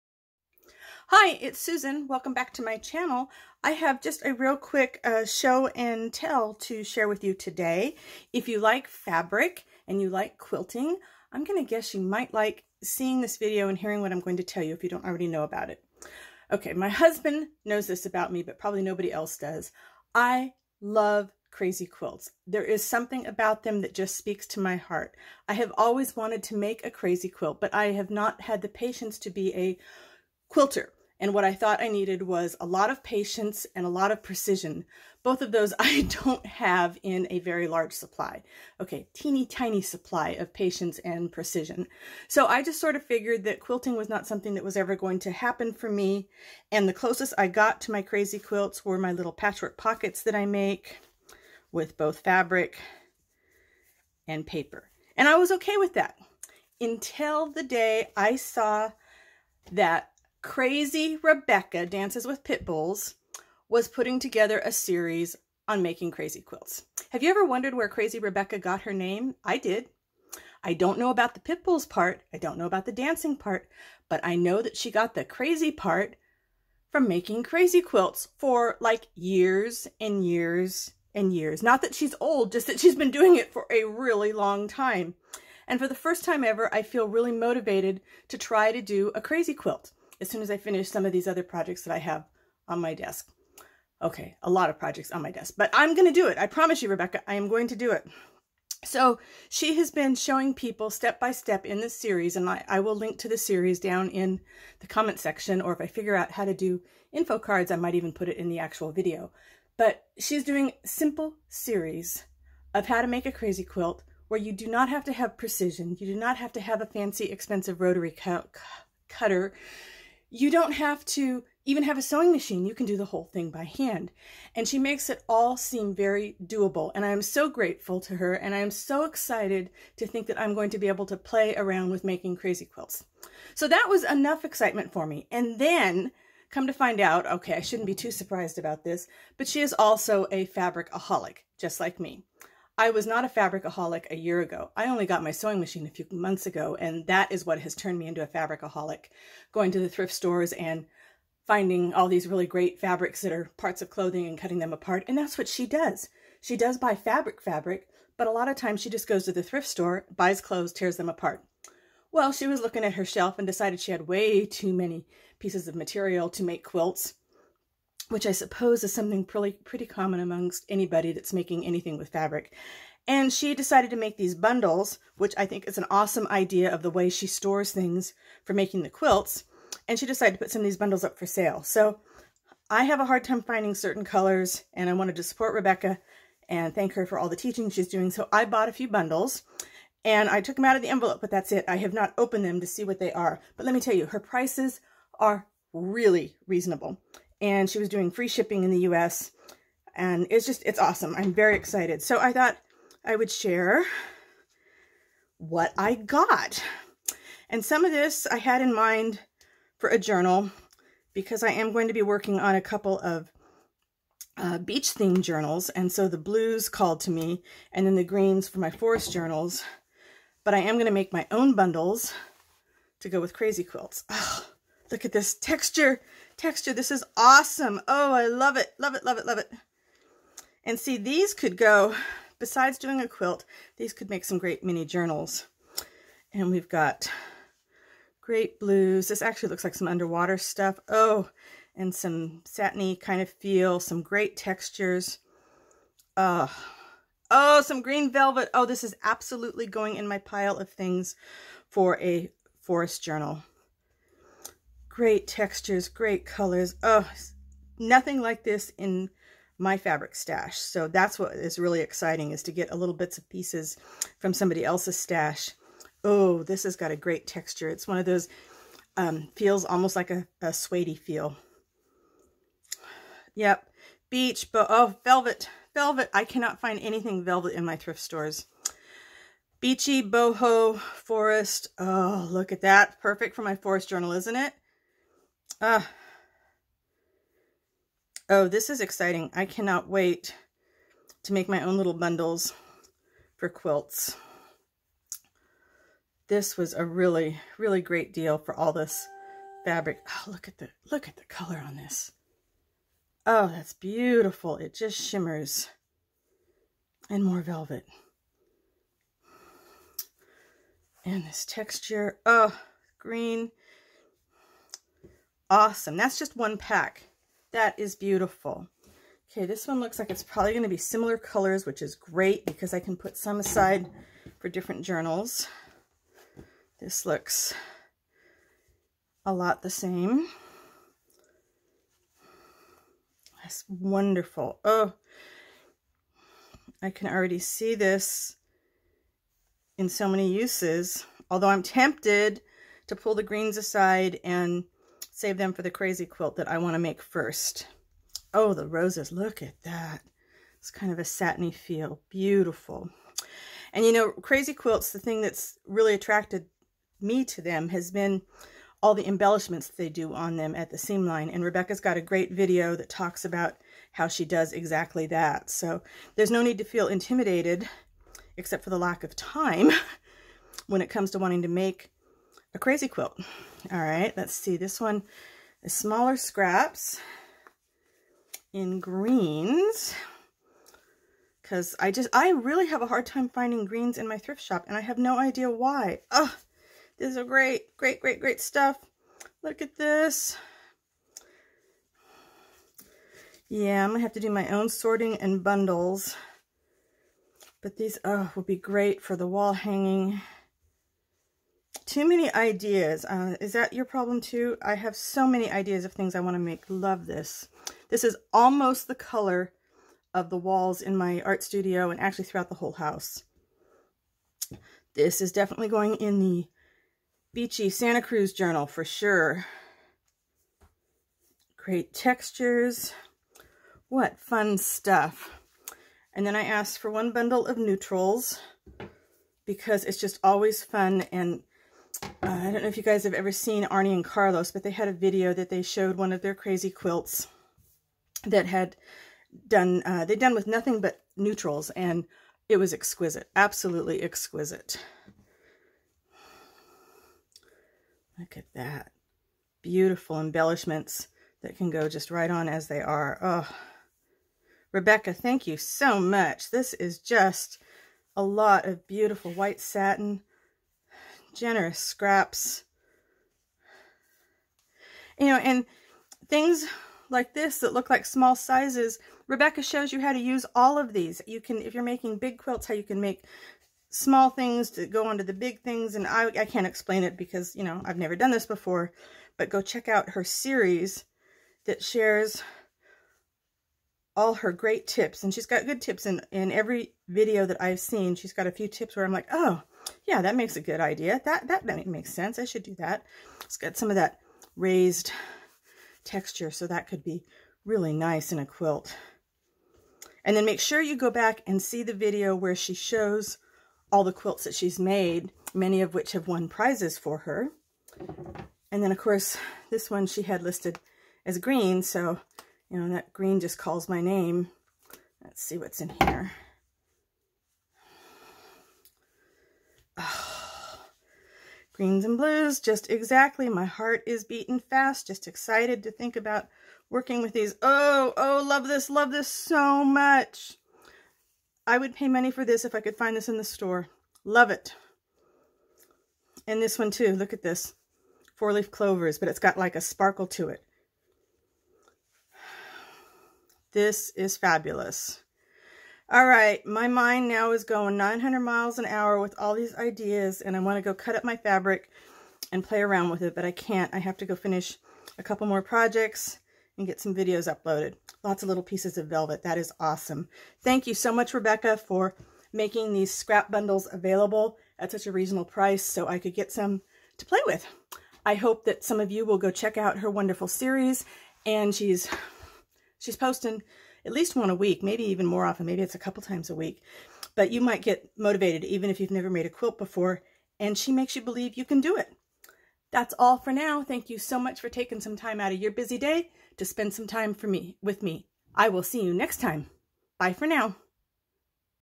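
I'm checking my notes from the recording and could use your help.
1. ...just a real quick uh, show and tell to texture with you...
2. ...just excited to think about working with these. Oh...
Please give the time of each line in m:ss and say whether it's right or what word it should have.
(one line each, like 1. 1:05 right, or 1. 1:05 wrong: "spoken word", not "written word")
1. 0:04 wrong: "share", not "texture"
2. 8:45 right.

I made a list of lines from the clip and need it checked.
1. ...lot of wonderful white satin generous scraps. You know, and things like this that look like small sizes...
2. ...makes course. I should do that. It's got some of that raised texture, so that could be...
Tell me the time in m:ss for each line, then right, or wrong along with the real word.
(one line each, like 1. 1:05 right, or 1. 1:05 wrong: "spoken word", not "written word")
1. 7:38 wrong: "beautiful", not "wonderful"
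2. 8:11 wrong: "sense", not "course".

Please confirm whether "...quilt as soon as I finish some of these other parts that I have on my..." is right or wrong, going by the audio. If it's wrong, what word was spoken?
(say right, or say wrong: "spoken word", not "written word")
wrong: "projects", not "parts".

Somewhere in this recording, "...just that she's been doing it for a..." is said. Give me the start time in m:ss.
1:22.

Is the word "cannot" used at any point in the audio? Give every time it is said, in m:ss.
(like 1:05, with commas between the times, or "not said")
4:36, 4:49.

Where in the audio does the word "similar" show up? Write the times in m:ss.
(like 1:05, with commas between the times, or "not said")
5:20.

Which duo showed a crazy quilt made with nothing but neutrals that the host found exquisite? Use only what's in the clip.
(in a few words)
Arne and Carlos.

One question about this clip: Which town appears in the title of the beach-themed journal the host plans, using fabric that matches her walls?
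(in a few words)
Santa Cruz.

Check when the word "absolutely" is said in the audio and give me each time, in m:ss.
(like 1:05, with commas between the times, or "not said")
4:09, 7:23.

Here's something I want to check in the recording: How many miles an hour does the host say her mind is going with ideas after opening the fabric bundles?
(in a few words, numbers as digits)
900.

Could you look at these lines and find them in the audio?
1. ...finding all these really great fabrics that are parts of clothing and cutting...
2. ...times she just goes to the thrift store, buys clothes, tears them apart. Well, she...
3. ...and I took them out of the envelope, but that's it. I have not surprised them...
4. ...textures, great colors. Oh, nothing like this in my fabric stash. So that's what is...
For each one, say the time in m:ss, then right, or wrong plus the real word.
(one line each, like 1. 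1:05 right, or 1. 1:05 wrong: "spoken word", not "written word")
1. 2:31 right
2. 2:38 right
3. 3:10 wrong: "opened", not "surprised"
4. 4:15 right.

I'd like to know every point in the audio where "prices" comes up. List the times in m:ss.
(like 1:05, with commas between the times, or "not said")
3:14, 9:25.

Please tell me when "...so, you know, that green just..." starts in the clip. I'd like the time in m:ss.
8:31.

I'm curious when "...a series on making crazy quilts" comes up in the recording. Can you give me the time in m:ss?
1:04.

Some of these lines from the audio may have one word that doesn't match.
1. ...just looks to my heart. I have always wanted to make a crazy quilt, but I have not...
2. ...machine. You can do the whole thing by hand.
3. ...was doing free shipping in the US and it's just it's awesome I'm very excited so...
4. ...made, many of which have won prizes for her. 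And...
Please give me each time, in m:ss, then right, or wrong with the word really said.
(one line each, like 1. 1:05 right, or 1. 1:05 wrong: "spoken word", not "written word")
1. 0:23 wrong: "speaks", not "looks"
2. 2:02 right
3. 3:17 right
4. 8:24 right.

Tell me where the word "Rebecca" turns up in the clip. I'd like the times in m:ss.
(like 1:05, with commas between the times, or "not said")
1:01, 1:08, 1:36, 3:05, 6:01, 7:34, 7:49, 9:21.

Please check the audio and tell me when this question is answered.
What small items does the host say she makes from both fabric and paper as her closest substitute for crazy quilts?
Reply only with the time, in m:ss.
0:49.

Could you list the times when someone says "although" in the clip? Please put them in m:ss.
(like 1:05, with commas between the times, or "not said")
5:41.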